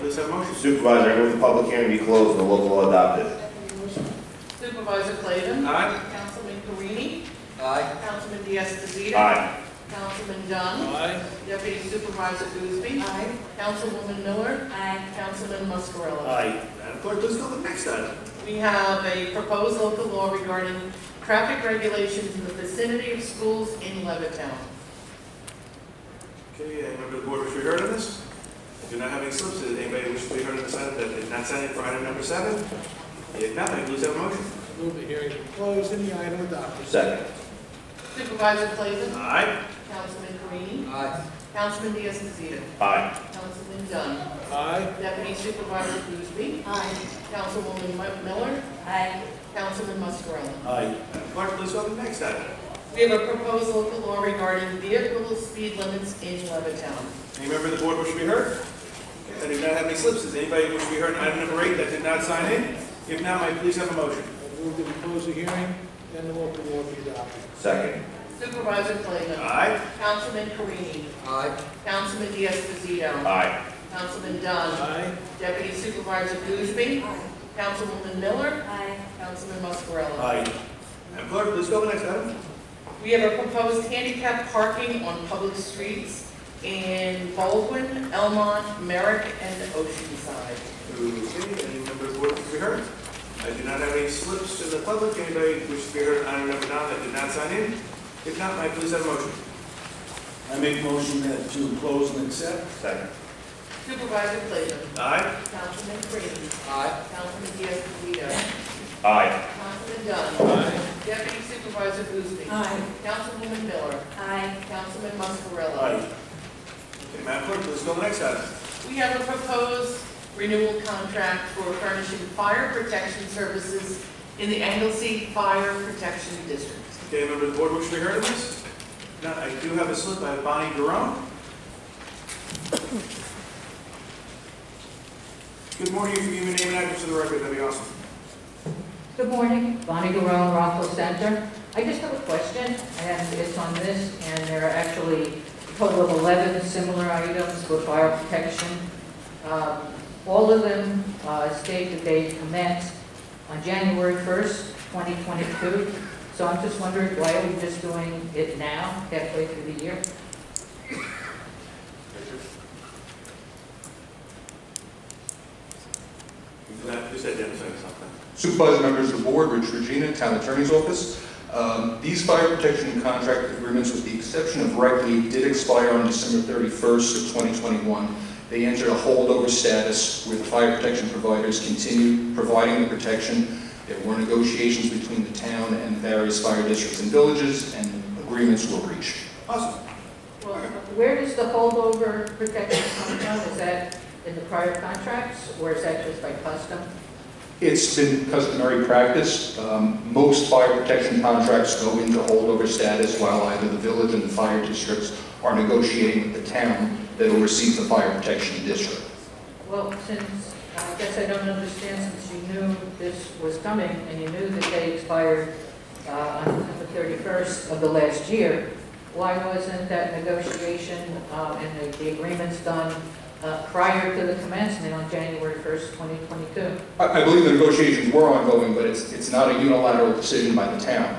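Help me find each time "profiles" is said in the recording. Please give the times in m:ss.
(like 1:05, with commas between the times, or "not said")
not said.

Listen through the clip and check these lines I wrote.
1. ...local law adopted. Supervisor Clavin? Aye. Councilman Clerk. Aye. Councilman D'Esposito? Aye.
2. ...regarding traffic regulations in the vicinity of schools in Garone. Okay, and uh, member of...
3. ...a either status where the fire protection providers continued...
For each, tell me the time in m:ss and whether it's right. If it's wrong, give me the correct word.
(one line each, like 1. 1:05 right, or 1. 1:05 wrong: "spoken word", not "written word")
1. 0:02 wrong: "Carini", not "Clerk"
2. 0:20 wrong: "Levittown", not "Garone"
3. 2:58 wrong: "holdover", not "either".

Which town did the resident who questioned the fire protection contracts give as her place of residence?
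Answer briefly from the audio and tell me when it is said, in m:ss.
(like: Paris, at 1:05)
Rockville Centre, at 2:20.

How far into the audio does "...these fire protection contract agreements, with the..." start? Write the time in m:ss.
2:52.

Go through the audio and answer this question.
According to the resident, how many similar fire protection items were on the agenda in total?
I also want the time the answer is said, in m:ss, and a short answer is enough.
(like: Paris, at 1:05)
11, at 2:26.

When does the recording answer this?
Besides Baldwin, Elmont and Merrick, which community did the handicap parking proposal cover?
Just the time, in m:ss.
1:29.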